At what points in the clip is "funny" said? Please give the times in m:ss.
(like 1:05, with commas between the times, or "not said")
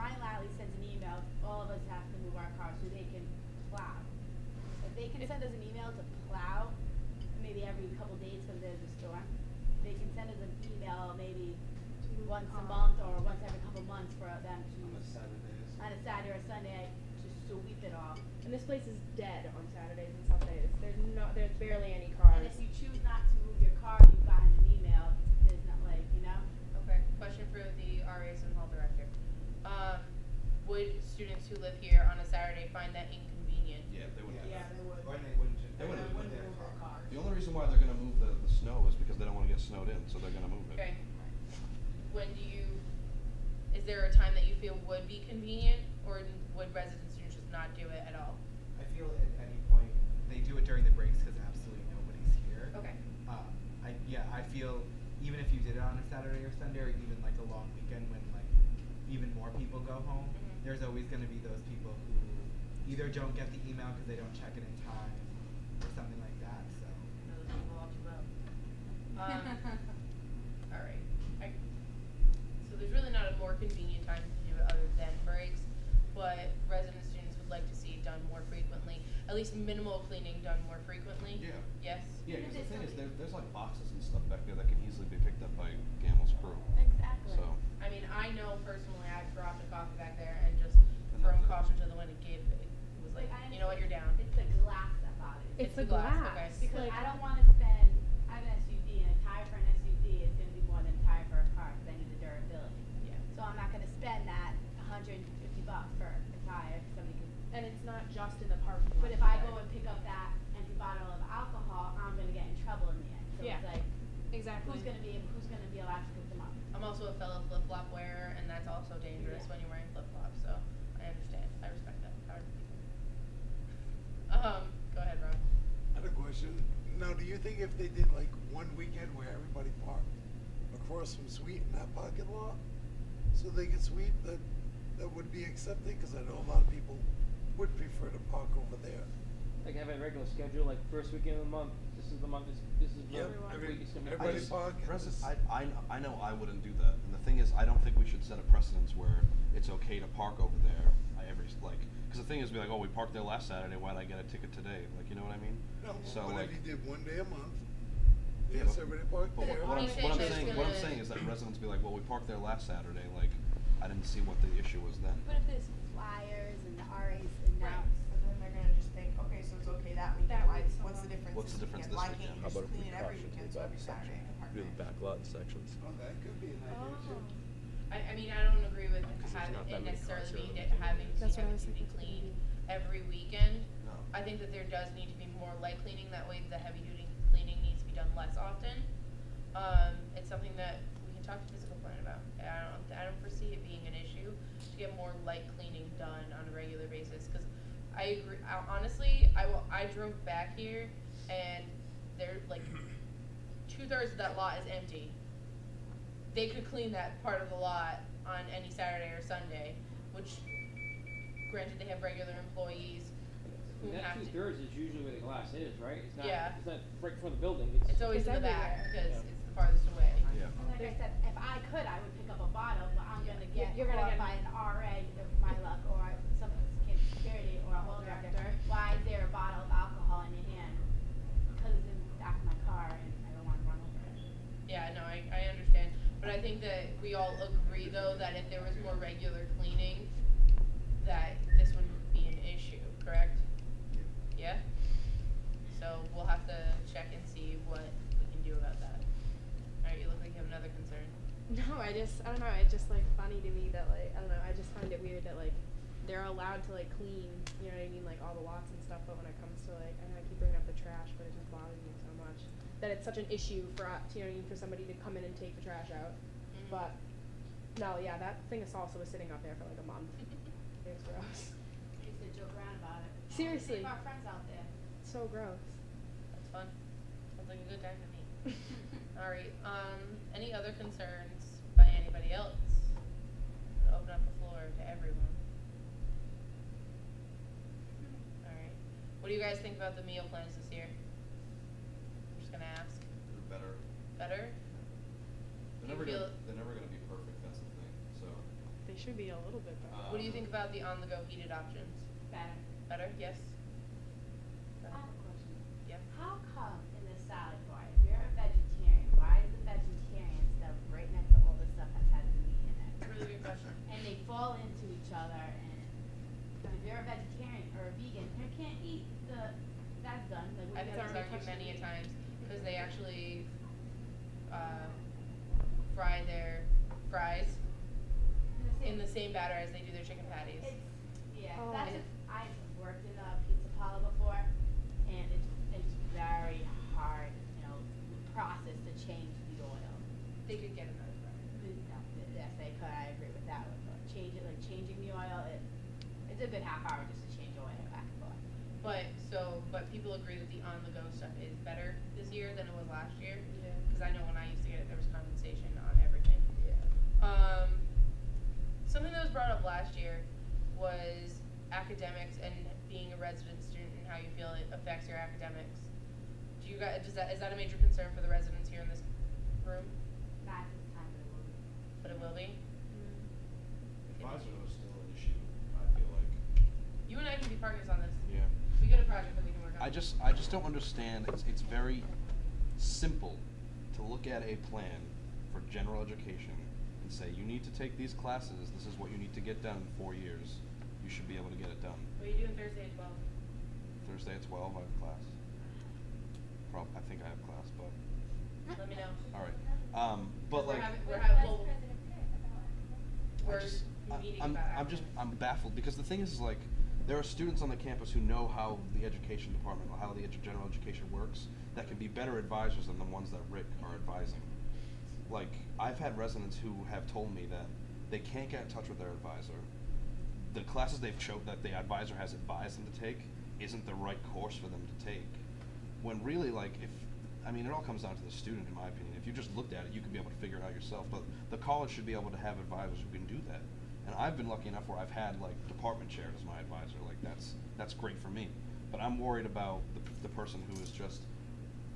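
4:13.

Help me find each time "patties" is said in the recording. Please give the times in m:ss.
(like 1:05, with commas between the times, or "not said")
5:30.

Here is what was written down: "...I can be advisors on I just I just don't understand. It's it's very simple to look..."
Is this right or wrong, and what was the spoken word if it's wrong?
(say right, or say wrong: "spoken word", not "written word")
wrong: "partners", not "advisors".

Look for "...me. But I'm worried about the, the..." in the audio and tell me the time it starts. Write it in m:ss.
7:18.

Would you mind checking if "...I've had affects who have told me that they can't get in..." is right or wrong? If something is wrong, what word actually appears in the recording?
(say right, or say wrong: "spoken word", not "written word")
wrong: "residents", not "affects".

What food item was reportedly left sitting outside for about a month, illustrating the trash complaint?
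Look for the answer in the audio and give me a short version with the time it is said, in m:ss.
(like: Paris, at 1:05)
Salsa, at 4:28.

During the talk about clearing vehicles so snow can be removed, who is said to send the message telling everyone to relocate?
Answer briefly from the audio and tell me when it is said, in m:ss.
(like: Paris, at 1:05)
Lally, at 0:00.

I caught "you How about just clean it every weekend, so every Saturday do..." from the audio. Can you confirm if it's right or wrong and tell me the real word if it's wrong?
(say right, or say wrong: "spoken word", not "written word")
right.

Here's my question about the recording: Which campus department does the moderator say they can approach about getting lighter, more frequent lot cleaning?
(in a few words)
Physical plant.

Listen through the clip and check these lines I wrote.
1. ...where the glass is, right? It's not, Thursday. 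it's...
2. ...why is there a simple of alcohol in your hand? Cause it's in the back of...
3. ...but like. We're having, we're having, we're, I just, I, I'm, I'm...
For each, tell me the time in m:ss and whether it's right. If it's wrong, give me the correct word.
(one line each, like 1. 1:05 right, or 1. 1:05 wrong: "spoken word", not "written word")
1. 3:35 wrong: "Yeah", not "Thursday"
2. 3:48 wrong: "bottle", not "simple"
3. 6:40 right.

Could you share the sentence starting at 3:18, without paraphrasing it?
I, honestly, I, will, I drove back here and there like two thirds of that lot is empty.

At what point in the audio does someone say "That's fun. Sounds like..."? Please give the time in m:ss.
4:36.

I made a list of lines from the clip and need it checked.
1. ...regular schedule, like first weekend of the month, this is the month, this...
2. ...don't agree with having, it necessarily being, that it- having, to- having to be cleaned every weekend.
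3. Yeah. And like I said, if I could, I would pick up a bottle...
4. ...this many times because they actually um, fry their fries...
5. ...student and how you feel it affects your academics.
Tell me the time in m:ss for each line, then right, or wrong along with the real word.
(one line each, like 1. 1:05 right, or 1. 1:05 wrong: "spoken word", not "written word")
1. 2:20 right
2. 2:58 right
3. 3:40 right
4. 5:21 right
5. 6:03 right.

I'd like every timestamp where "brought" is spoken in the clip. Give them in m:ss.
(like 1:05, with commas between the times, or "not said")
5:59.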